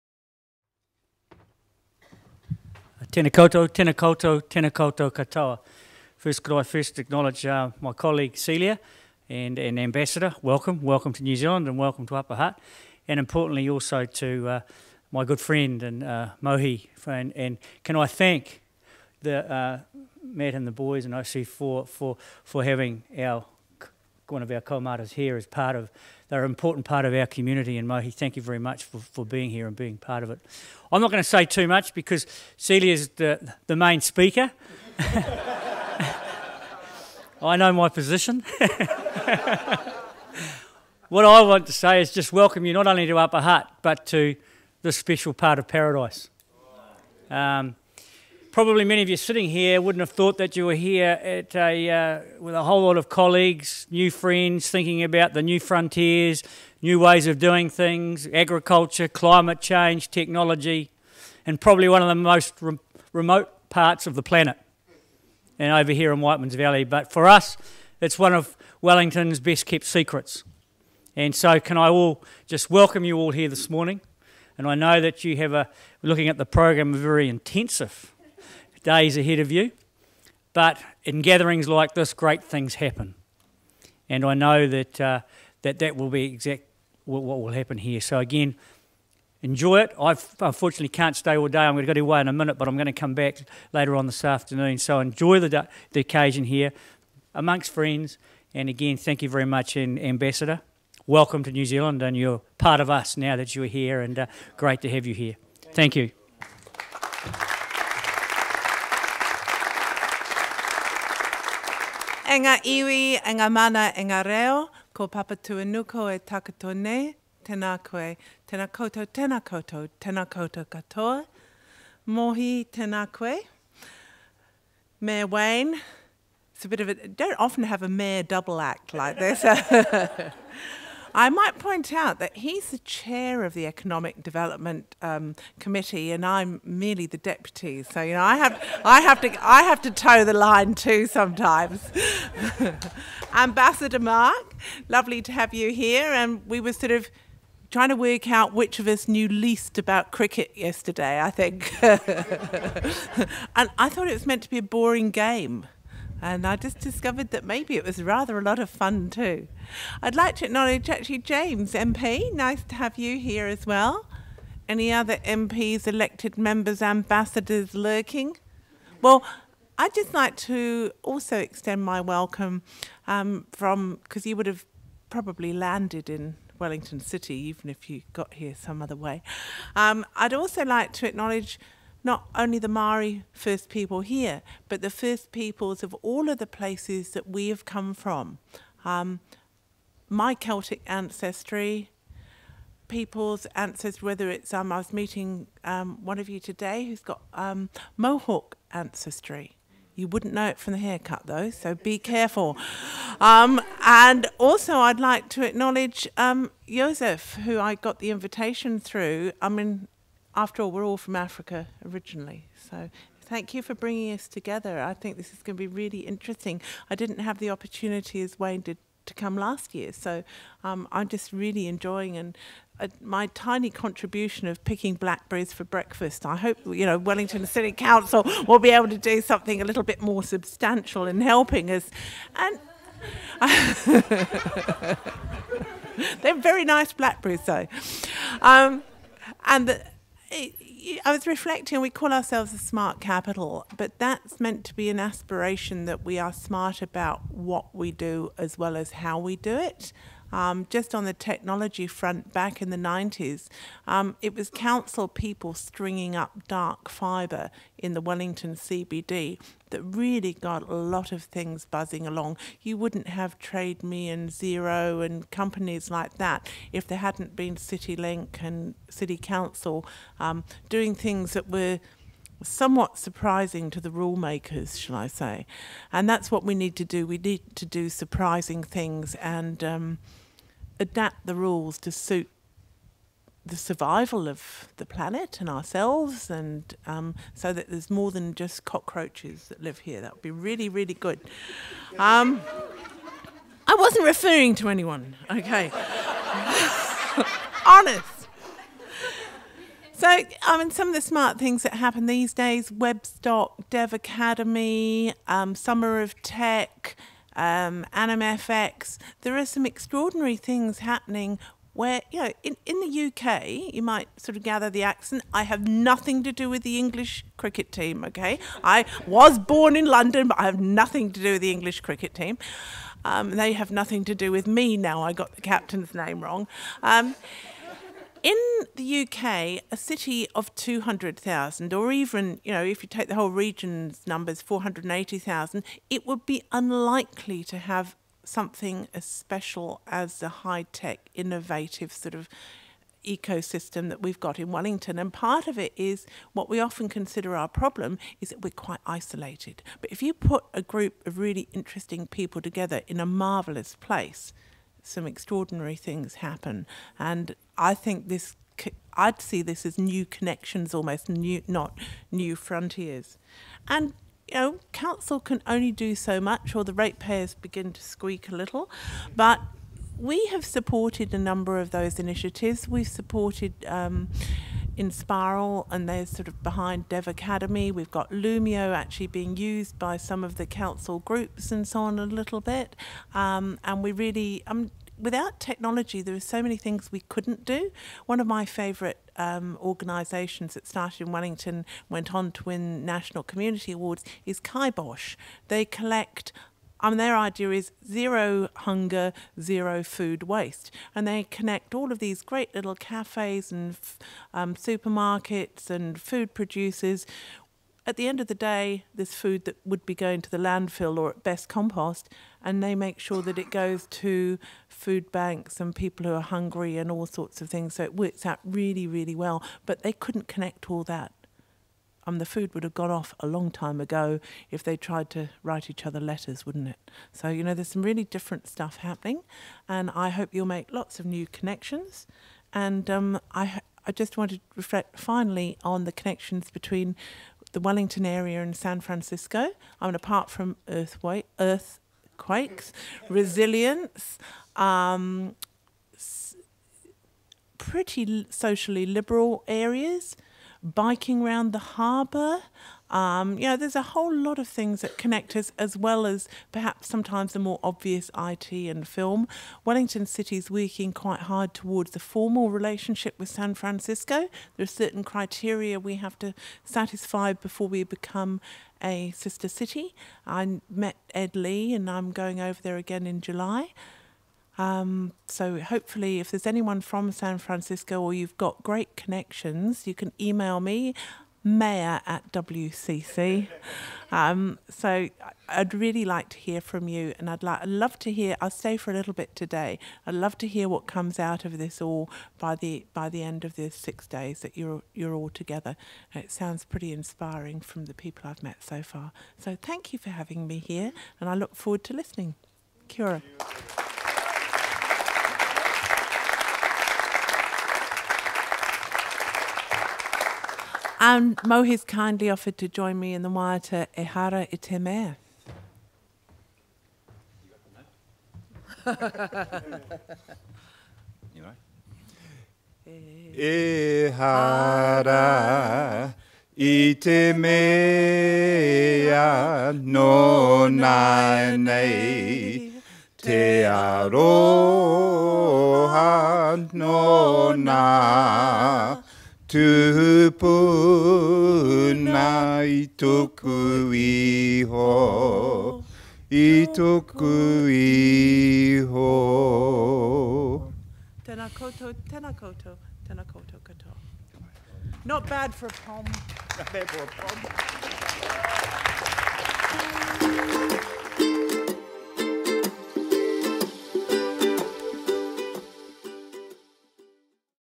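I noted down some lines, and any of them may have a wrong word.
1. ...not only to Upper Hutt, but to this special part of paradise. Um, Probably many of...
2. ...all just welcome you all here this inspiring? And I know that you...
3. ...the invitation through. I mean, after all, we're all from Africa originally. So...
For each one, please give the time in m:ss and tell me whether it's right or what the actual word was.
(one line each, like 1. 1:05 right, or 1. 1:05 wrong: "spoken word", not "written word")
1. 0:42 right
2. 1:11 wrong: "morning", not "inspiring"
3. 3:27 right.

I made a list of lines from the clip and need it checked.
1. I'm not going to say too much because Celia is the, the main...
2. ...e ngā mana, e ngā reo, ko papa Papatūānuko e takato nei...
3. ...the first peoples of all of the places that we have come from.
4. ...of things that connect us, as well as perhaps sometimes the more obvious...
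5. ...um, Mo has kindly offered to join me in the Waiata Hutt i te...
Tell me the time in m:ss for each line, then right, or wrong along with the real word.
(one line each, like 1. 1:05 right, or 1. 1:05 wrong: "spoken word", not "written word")
1. 0:30 right
2. 1:53 right
3. 3:04 right
4. 7:34 right
5. 8:31 wrong: "Ehara", not "Hutt".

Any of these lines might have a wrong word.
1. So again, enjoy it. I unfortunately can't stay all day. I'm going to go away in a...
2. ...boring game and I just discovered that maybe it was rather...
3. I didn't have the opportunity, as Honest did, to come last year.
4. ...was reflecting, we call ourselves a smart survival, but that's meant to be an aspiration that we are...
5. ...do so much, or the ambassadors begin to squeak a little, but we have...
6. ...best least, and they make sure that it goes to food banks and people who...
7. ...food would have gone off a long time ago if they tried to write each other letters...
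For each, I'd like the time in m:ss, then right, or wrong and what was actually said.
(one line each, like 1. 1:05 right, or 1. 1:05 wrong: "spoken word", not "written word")
1. 1:28 right
2. 2:34 right
3. 3:36 wrong: "Wayne", not "Honest"
4. 4:01 wrong: "capital", not "survival"
5. 6:05 wrong: "ratepayers", not "ambassadors"
6. 6:51 wrong: "compost", not "least"
7. 7:02 right.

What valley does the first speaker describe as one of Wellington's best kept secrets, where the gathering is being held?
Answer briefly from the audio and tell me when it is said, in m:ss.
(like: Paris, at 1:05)
Whiteman's Valley, at 1:06.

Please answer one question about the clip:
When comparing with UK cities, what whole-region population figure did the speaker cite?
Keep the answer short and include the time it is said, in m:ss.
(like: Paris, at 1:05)
480,000, at 5:34.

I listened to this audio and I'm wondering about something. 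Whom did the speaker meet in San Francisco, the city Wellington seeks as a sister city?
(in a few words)
Ed Lee.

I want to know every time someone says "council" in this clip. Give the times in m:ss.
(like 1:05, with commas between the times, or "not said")
3:47, 4:14, 4:29, 6:04, 6:20.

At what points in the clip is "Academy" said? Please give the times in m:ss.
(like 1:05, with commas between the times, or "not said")
5:03, 6:17.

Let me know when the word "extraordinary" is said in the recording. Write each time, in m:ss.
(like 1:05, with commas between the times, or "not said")
5:09, 5:55.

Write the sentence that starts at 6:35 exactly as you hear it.
They collect mean, their idea is zero hunger, zero food waste.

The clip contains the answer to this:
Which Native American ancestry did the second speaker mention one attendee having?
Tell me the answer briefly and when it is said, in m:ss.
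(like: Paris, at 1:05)
Mohawk, at 3:17.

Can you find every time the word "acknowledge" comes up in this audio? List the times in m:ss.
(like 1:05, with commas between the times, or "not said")
0:06, 2:40, 3:01, 3:25.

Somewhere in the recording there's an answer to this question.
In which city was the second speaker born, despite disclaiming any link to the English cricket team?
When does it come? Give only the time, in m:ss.
5:19.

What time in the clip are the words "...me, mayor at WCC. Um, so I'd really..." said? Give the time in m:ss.
8:00.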